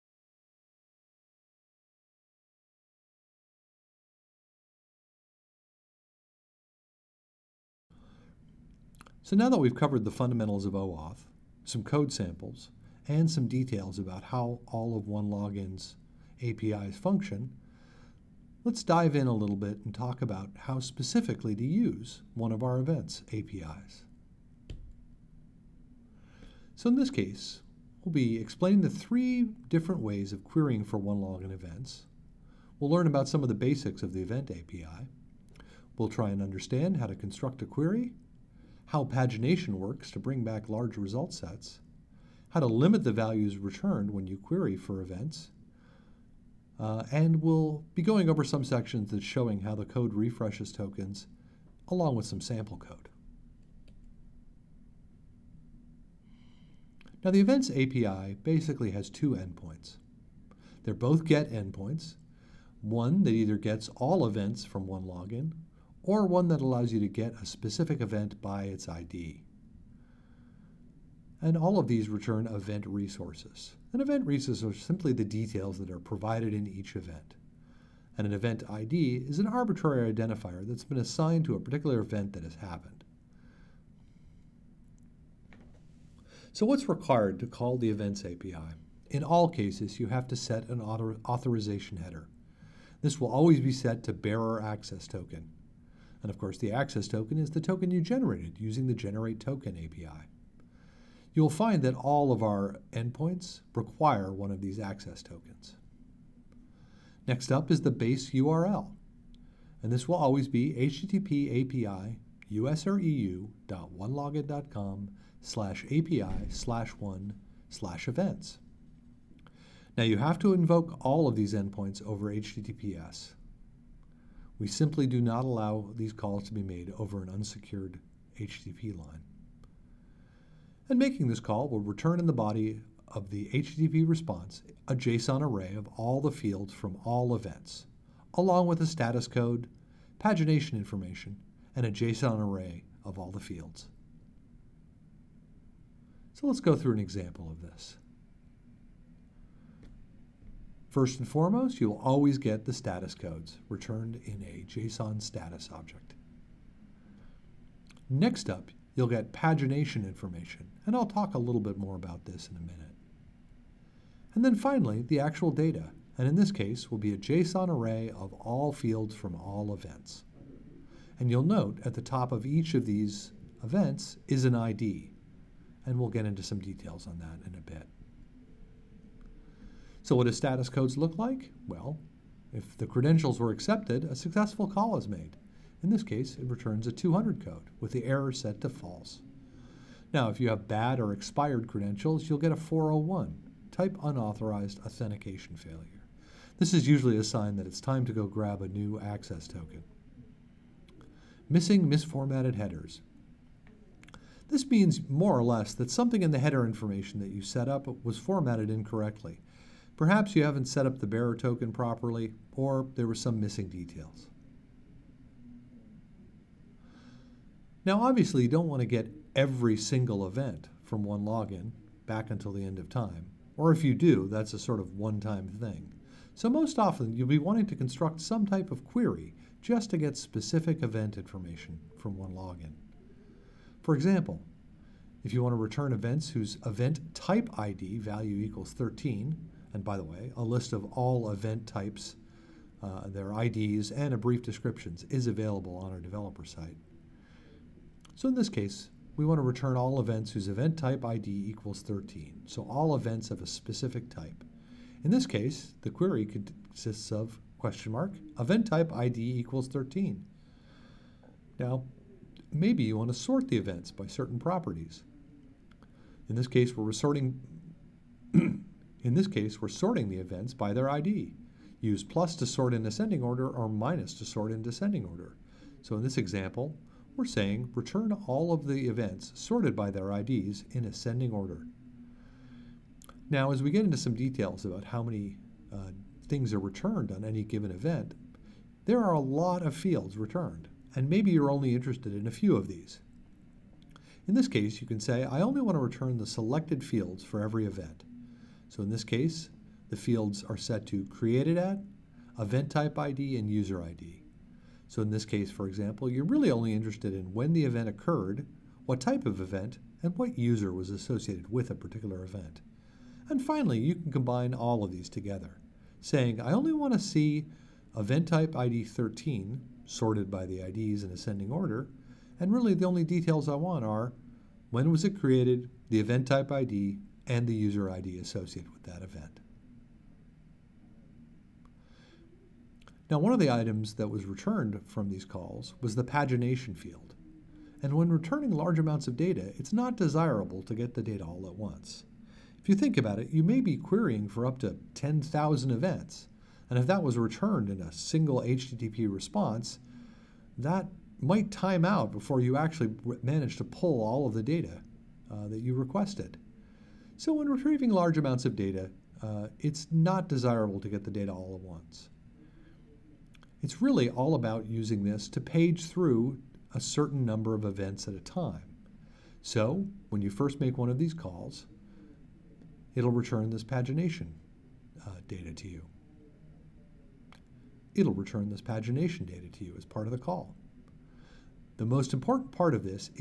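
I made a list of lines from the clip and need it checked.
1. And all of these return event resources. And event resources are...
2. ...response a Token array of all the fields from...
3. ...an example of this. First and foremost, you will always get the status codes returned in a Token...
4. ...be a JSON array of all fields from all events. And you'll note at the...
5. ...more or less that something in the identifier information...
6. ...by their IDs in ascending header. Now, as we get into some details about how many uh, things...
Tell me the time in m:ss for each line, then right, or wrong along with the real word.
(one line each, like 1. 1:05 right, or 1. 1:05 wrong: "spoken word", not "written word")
1. 1:11 right
2. 2:14 wrong: "JSON", not "Token"
3. 2:26 wrong: "JSON", not "Token"
4. 2:46 right
5. 3:25 wrong: "header", not "identifier"
6. 4:39 wrong: "order", not "header".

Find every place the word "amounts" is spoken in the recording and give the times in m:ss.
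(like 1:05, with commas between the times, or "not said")
5:38, 5:58.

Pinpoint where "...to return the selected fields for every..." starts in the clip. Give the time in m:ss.
4:55.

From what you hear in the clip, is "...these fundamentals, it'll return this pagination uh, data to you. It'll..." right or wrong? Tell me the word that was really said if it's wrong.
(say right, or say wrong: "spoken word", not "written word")
wrong: "calls", not "fundamentals".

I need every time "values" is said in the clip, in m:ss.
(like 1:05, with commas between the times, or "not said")
0:43, 3:57.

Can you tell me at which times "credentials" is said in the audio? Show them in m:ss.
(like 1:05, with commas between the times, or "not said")
3:02, 3:11.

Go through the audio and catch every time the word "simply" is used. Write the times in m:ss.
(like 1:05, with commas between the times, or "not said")
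1:14, 2:04.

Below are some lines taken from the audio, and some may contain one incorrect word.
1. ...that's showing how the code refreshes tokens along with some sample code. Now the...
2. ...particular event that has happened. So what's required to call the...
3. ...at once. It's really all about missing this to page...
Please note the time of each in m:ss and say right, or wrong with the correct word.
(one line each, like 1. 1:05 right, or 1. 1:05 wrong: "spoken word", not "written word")
1. 0:49 right
2. 1:21 right
3. 6:01 wrong: "using", not "missing".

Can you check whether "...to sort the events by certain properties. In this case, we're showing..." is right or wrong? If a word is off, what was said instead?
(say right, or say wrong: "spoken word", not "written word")
wrong: "sorting", not "showing".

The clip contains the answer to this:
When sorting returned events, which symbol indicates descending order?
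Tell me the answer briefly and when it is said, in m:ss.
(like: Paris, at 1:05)
minus, at 4:33.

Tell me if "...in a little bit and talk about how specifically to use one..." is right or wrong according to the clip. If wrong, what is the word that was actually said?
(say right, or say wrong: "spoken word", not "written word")
right.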